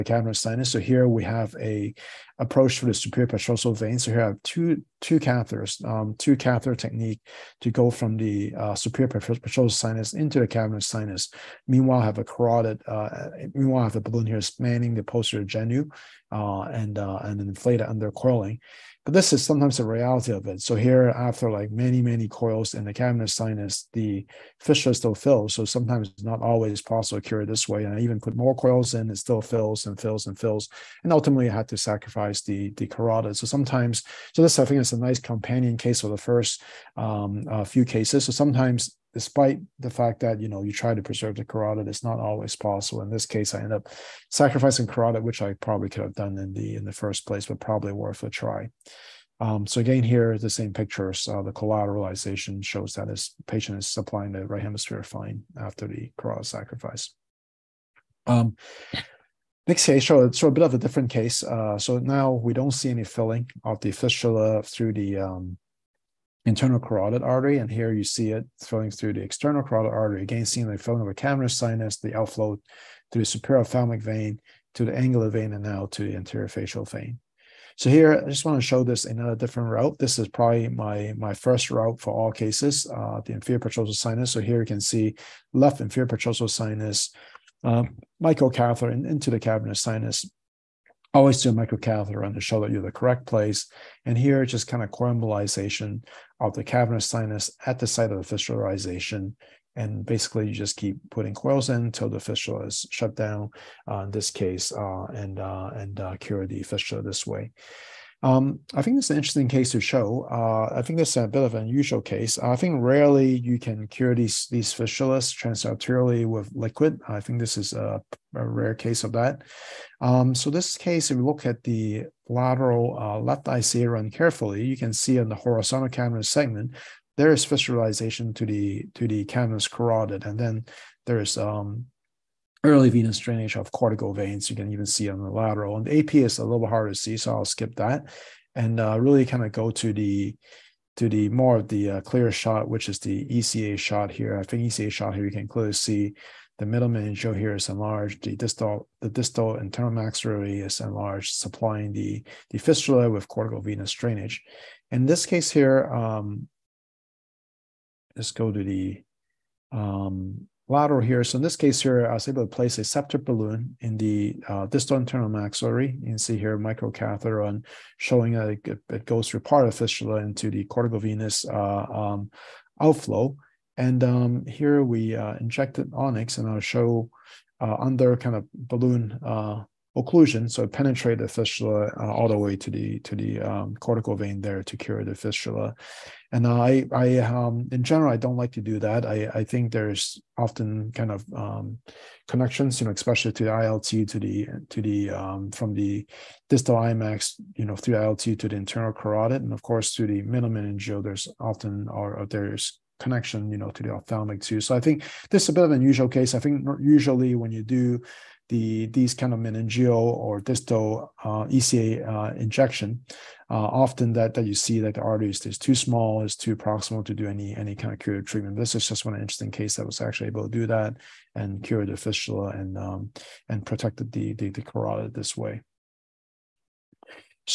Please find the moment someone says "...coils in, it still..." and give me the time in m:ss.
0:28.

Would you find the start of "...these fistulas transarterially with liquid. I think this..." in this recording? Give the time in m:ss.
1:54.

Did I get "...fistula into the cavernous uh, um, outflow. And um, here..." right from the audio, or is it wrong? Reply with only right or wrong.
wrong.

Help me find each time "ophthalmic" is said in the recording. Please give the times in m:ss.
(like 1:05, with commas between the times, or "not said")
1:13, 3:23.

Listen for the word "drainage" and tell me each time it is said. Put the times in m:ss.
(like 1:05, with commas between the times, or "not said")
2:13, 2:33.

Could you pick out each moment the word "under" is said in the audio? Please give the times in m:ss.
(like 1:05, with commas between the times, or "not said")
0:17, 2:57.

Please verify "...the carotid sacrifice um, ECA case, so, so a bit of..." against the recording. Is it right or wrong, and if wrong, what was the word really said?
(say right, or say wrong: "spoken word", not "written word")
wrong: "Next", not "ECA".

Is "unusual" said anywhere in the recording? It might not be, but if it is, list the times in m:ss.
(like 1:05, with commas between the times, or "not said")
1:51, 3:25.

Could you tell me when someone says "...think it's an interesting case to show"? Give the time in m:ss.
1:48.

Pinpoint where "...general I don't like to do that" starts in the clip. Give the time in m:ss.
3:07.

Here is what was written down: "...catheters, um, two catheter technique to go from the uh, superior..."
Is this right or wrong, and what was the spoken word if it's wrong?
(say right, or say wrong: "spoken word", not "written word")
right.